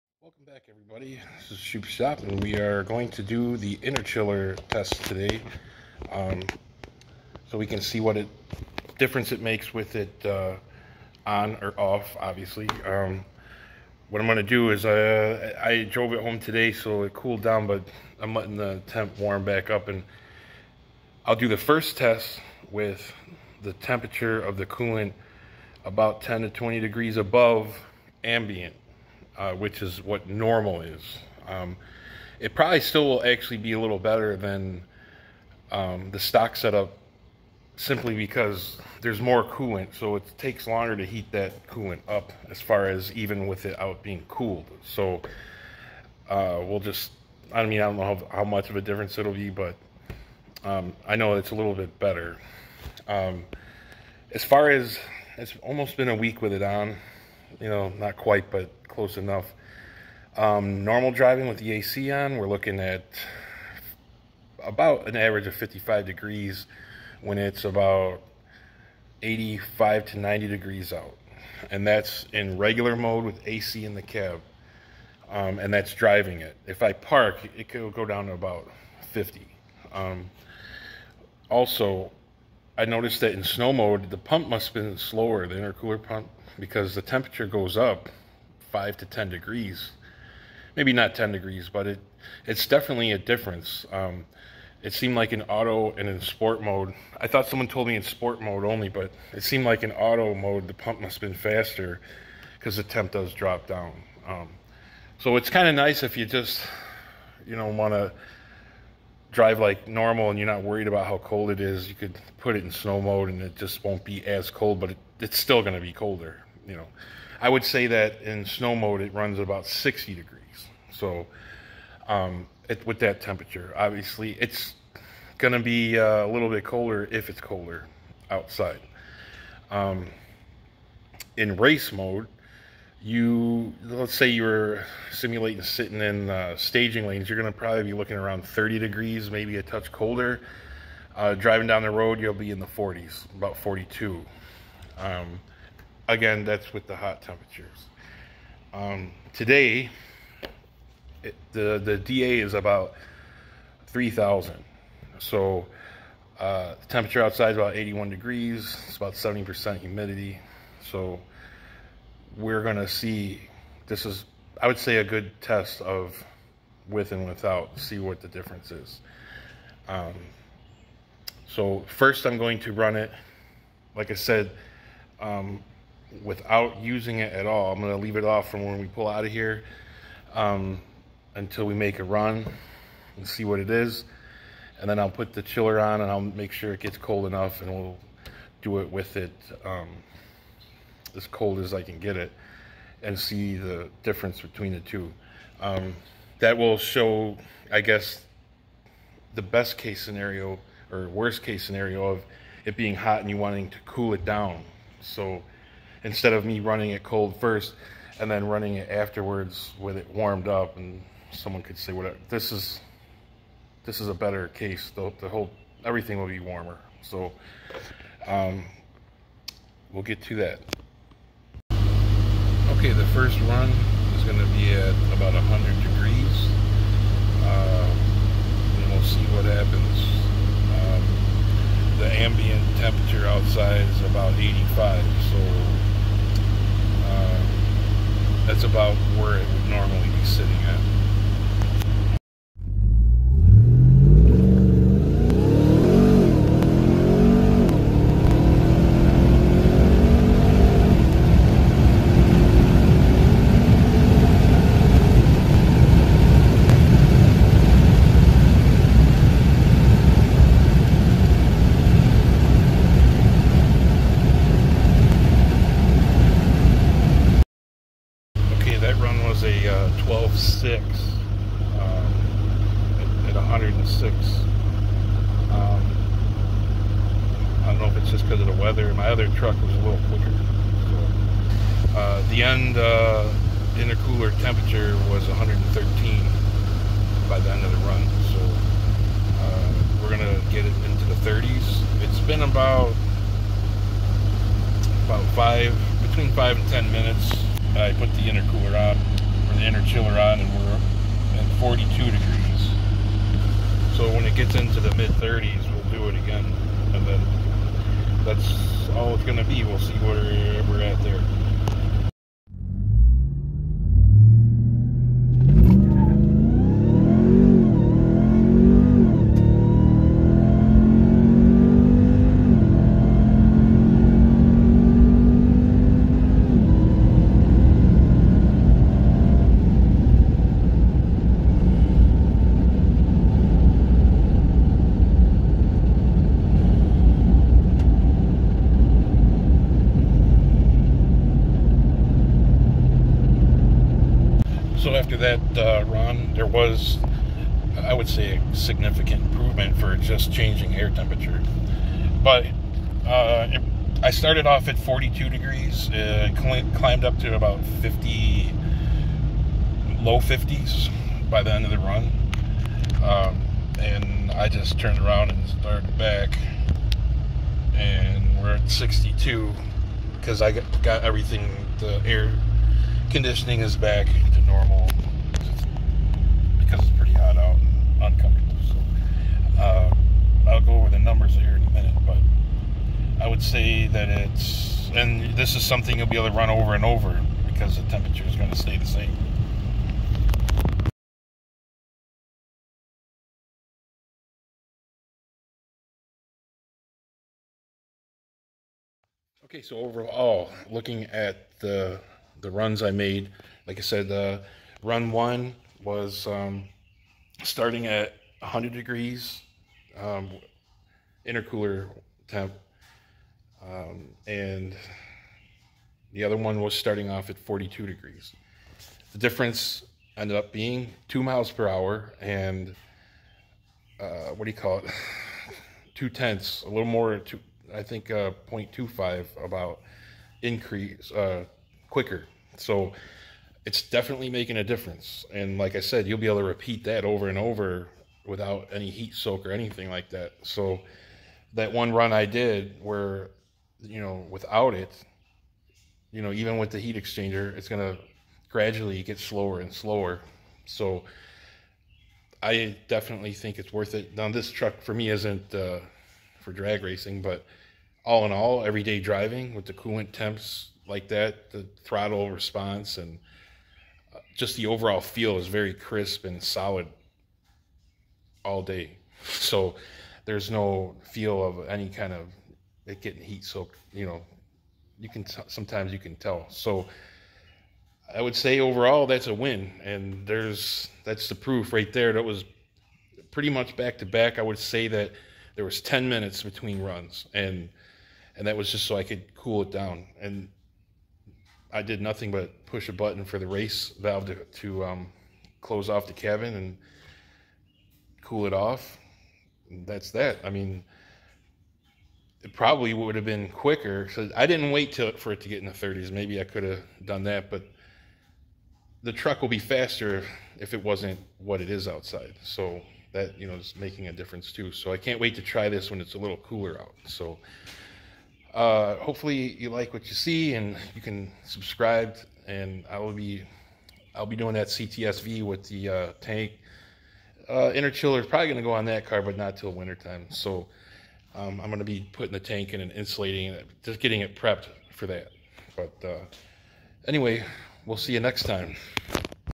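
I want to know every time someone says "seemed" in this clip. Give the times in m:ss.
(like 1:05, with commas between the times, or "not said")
1:34, 1:39.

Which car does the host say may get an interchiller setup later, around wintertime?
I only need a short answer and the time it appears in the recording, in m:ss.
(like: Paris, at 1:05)
CTSV, at 8:44.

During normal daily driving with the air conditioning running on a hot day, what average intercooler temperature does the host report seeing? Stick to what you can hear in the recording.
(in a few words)
55 degrees.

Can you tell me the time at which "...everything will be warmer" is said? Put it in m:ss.
3:35.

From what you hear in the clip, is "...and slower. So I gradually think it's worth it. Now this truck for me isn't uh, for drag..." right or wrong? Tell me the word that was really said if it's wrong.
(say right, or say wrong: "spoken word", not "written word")
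wrong: "definitely", not "gradually".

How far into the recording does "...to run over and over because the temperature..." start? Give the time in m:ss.
6:26.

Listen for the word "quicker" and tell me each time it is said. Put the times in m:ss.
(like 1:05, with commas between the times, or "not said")
4:40, 7:11, 8:23.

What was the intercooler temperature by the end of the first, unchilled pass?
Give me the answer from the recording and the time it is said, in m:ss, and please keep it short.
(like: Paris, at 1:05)
113, at 4:45.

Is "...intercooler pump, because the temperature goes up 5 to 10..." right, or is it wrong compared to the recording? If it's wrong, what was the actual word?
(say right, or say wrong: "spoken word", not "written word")
right.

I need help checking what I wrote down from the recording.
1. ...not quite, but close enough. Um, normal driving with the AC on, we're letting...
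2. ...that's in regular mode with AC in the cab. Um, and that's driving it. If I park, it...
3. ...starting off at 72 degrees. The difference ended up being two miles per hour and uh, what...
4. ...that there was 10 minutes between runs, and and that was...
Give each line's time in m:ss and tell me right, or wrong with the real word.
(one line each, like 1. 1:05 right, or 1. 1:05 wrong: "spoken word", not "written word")
1. 0:57 wrong: "looking", not "letting"
2. 1:11 right
3. 6:56 wrong: "42", not "72"
4. 8:04 right.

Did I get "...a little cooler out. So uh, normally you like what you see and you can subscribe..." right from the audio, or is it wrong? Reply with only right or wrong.
wrong.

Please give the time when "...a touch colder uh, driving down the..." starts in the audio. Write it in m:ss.
2:19.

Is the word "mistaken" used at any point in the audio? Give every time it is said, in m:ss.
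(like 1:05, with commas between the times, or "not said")
not said.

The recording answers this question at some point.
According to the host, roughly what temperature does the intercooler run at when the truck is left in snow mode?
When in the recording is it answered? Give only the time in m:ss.
1:59.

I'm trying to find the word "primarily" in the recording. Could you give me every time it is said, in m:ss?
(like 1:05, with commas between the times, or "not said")
not said.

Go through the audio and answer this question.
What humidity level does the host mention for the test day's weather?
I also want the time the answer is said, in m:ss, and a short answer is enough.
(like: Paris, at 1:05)
70%, at 2:39.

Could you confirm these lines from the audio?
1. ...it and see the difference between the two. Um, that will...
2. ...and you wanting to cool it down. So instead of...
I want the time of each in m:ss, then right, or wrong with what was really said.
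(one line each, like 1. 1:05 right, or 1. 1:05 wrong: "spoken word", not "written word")
1. 3:12 right
2. 3:23 right.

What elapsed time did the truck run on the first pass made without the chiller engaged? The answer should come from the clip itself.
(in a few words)
12.6.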